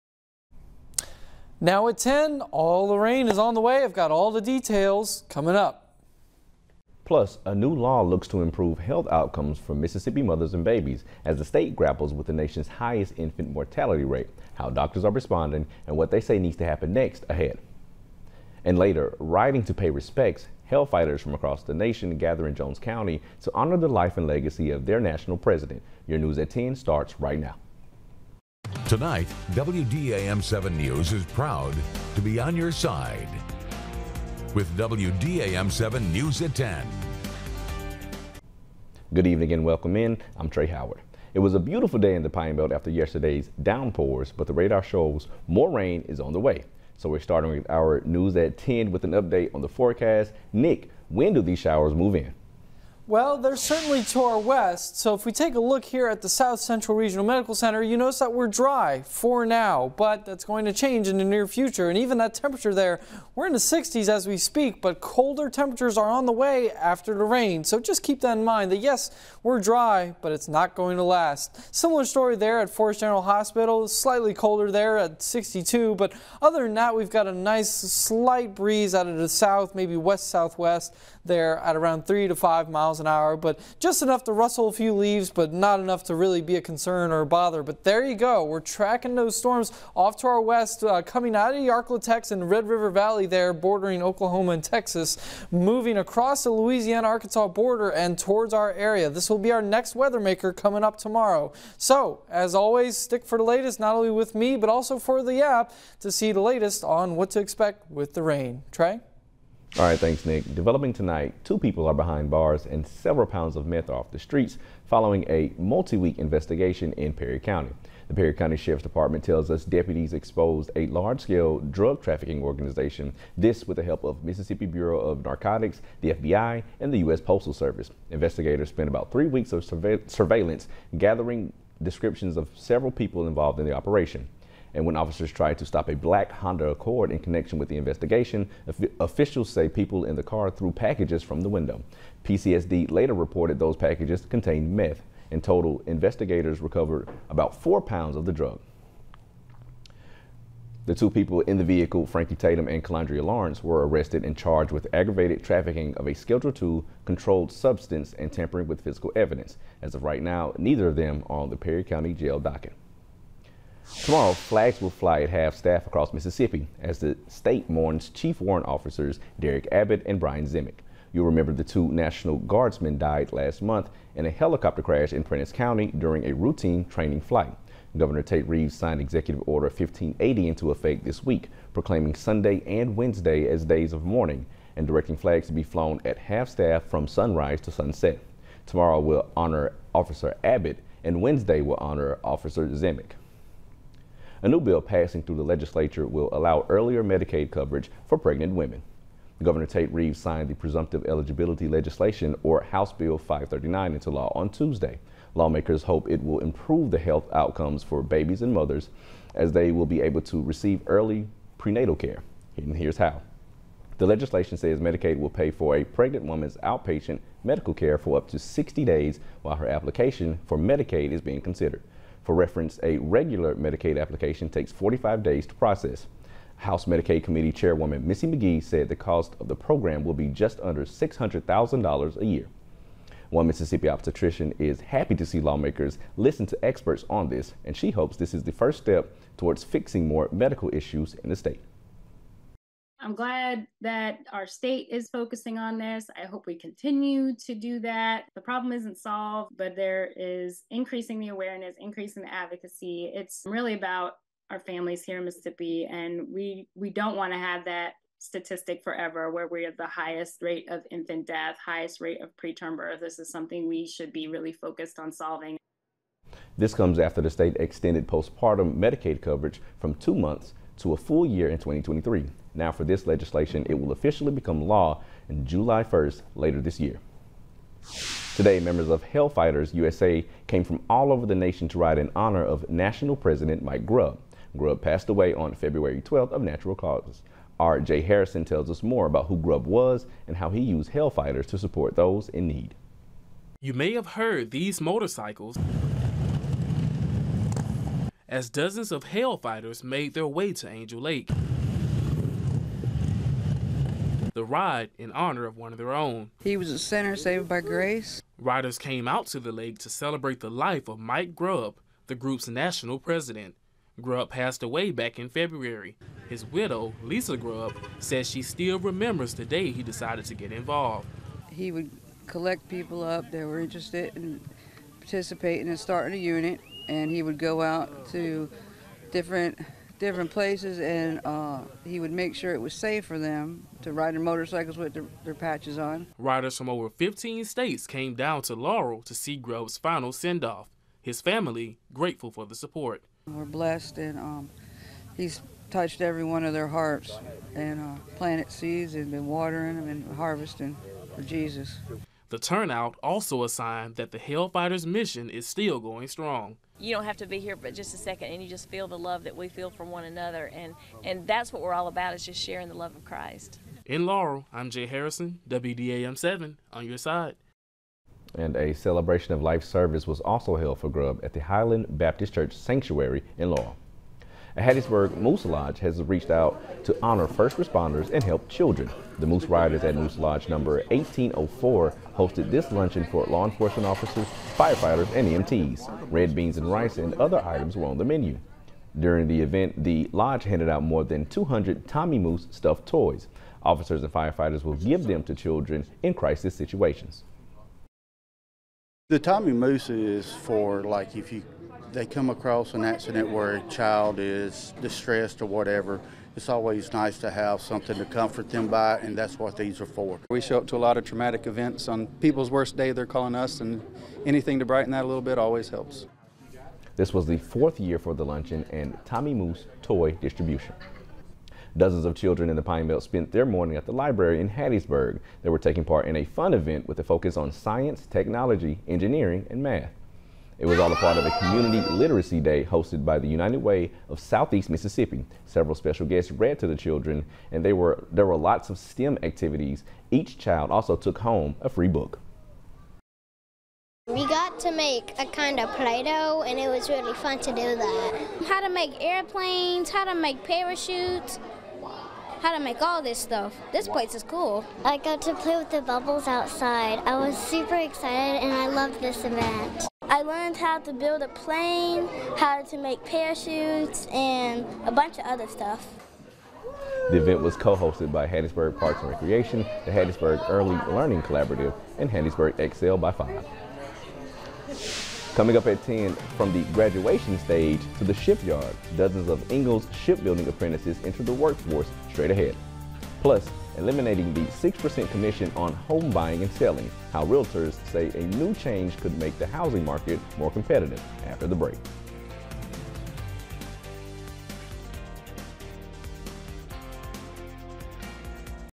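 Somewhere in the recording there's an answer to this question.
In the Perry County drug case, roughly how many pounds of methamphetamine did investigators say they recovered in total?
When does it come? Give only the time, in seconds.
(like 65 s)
147 s.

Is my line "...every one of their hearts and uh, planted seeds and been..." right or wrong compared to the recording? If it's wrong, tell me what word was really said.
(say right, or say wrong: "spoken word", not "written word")
right.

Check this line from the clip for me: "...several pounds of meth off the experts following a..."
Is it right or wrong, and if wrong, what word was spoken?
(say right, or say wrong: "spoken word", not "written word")
wrong: "streets", not "experts".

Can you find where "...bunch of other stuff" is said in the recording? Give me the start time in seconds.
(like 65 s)
464 s.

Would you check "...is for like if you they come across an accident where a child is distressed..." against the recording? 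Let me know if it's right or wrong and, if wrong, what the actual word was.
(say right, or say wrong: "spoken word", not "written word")
right.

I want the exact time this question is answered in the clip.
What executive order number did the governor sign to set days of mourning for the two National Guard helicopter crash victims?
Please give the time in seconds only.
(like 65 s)
179 s.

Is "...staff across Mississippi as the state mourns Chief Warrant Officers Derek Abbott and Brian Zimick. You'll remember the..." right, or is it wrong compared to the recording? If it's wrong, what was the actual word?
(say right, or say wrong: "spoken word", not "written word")
right.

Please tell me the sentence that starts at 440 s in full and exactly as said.
Each child also took home a free book.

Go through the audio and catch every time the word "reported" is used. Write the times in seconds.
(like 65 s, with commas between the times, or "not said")
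143 s.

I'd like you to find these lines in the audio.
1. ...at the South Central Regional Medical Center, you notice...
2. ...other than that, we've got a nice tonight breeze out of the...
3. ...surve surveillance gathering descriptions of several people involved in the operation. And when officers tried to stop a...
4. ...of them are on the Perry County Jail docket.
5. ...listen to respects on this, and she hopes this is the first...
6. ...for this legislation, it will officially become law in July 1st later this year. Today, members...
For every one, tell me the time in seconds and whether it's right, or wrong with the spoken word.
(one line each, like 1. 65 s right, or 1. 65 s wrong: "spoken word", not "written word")
1. 56 s right
2. 76 s wrong: "slight", not "tonight"
3. 129 s right
4. 160 s right
5. 236 s wrong: "experts", not "respects"
6. 272 s right.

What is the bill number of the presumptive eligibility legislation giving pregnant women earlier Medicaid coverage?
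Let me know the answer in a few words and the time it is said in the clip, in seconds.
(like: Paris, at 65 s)
House Bill 539, at 202 s.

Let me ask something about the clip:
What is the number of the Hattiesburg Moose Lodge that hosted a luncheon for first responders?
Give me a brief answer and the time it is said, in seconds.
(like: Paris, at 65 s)
1804, at 380 s.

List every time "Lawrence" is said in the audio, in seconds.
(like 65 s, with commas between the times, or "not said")
153 s.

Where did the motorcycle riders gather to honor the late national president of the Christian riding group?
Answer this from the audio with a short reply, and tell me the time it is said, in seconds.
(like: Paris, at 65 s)
Angel Lake, at 300 s.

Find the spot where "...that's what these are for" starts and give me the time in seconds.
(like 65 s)
409 s.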